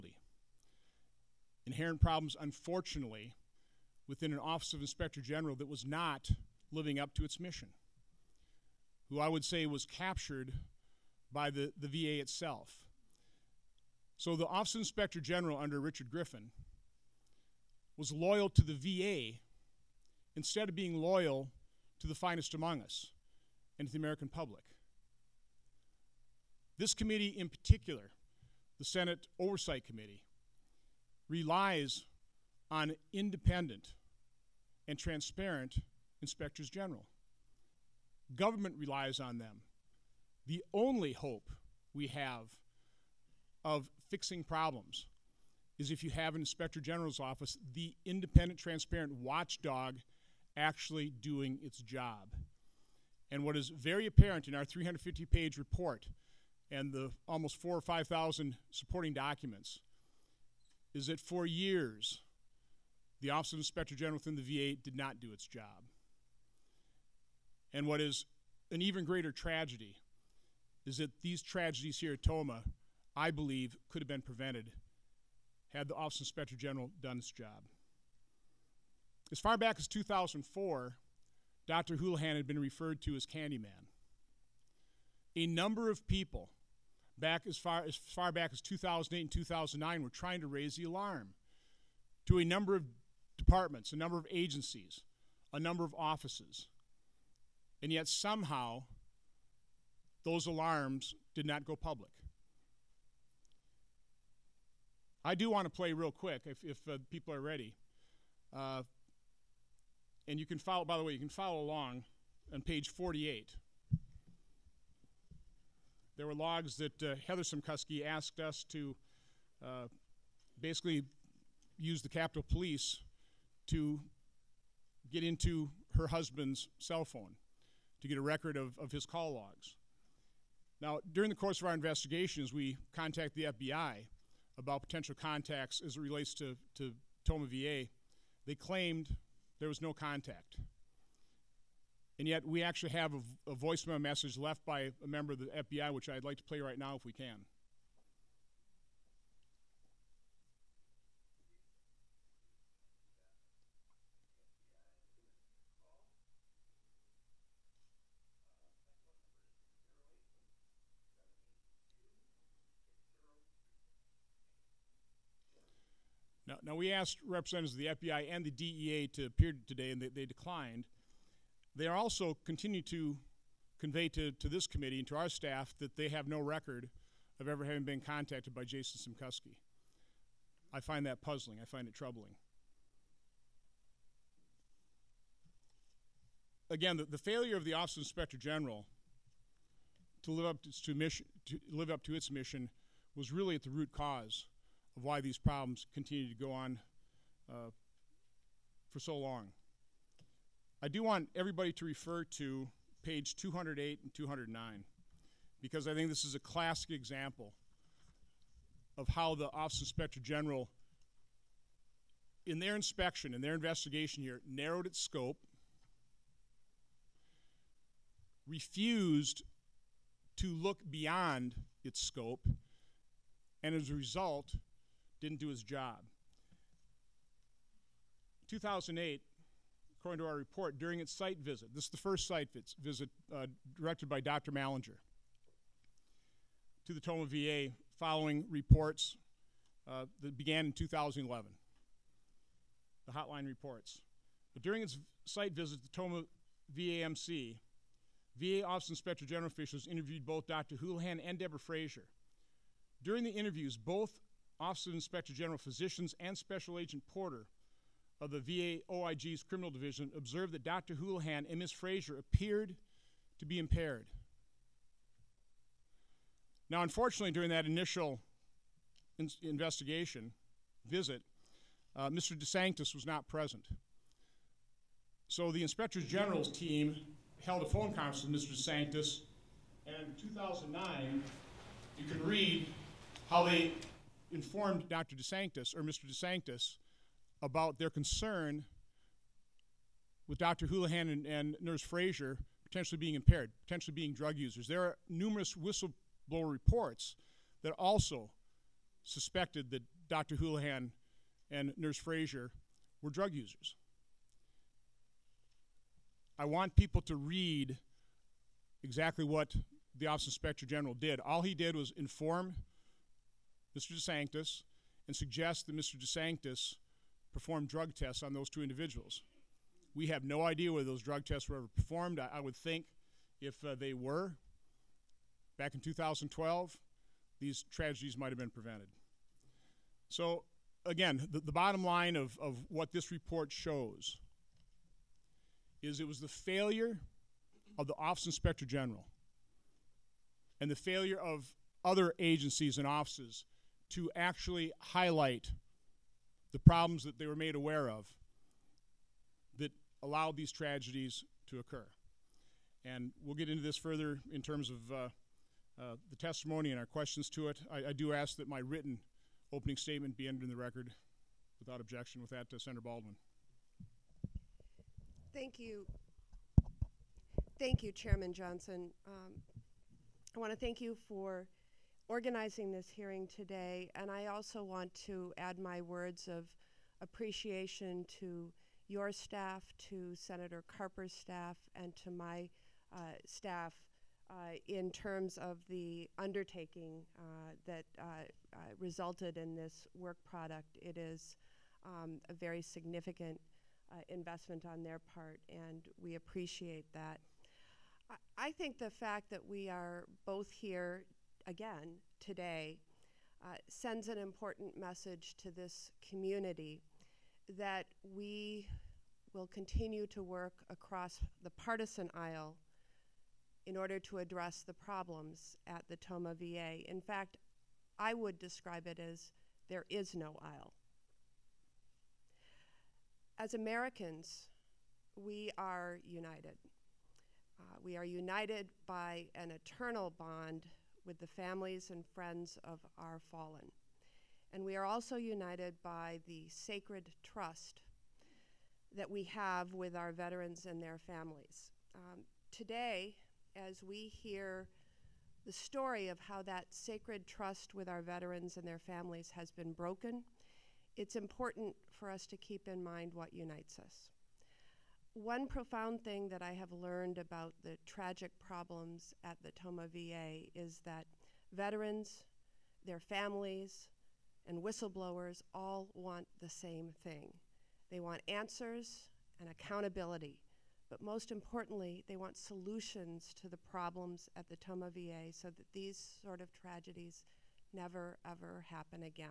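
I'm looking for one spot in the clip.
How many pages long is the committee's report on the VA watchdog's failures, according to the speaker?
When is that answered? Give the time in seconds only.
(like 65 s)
54 s.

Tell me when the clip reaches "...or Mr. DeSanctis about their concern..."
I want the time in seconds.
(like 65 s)
285 s.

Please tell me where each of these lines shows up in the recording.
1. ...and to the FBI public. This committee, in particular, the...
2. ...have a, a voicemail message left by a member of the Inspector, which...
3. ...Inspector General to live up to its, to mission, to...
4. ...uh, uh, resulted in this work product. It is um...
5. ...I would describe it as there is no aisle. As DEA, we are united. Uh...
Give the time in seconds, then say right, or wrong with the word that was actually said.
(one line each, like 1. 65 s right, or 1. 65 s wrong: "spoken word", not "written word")
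1. 23 s wrong: "American", not "FBI"
2. 142 s wrong: "FBI", not "Inspector"
3. 188 s right
4. 387 s right
5. 417 s wrong: "Americans", not "DEA".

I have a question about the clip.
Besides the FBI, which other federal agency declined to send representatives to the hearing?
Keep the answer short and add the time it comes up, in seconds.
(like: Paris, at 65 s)
DEA, at 168 s.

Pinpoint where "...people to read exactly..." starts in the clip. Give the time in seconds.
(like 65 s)
306 s.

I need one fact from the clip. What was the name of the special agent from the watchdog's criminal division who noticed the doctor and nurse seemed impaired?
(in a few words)
Porter.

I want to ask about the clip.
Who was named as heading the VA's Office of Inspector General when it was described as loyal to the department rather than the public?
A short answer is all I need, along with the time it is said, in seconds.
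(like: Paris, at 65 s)
Richard Griffin, at 15 s.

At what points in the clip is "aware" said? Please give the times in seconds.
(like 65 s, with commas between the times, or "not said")
347 s.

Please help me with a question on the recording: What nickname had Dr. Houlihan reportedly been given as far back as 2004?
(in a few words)
Candyman.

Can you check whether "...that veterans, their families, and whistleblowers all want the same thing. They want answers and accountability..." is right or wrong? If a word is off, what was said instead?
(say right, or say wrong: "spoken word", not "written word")
right.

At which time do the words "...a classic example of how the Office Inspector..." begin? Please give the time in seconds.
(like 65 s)
206 s.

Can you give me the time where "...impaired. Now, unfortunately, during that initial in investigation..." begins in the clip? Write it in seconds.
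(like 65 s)
263 s.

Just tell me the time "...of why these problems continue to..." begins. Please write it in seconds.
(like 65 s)
194 s.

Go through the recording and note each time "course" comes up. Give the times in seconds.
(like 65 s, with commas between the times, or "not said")
131 s.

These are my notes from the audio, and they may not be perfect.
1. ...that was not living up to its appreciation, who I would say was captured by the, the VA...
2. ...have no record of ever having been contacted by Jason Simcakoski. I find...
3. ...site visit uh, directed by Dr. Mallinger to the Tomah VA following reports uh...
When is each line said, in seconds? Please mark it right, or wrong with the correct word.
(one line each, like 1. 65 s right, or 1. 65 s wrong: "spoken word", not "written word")
1. 5 s wrong: "mission", not "appreciation"
2. 176 s right
3. 232 s right.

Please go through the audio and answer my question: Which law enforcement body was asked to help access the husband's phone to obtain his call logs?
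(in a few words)
Capitol Police.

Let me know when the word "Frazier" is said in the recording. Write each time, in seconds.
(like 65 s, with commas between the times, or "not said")
251 s, 261 s, 291 s, 301 s.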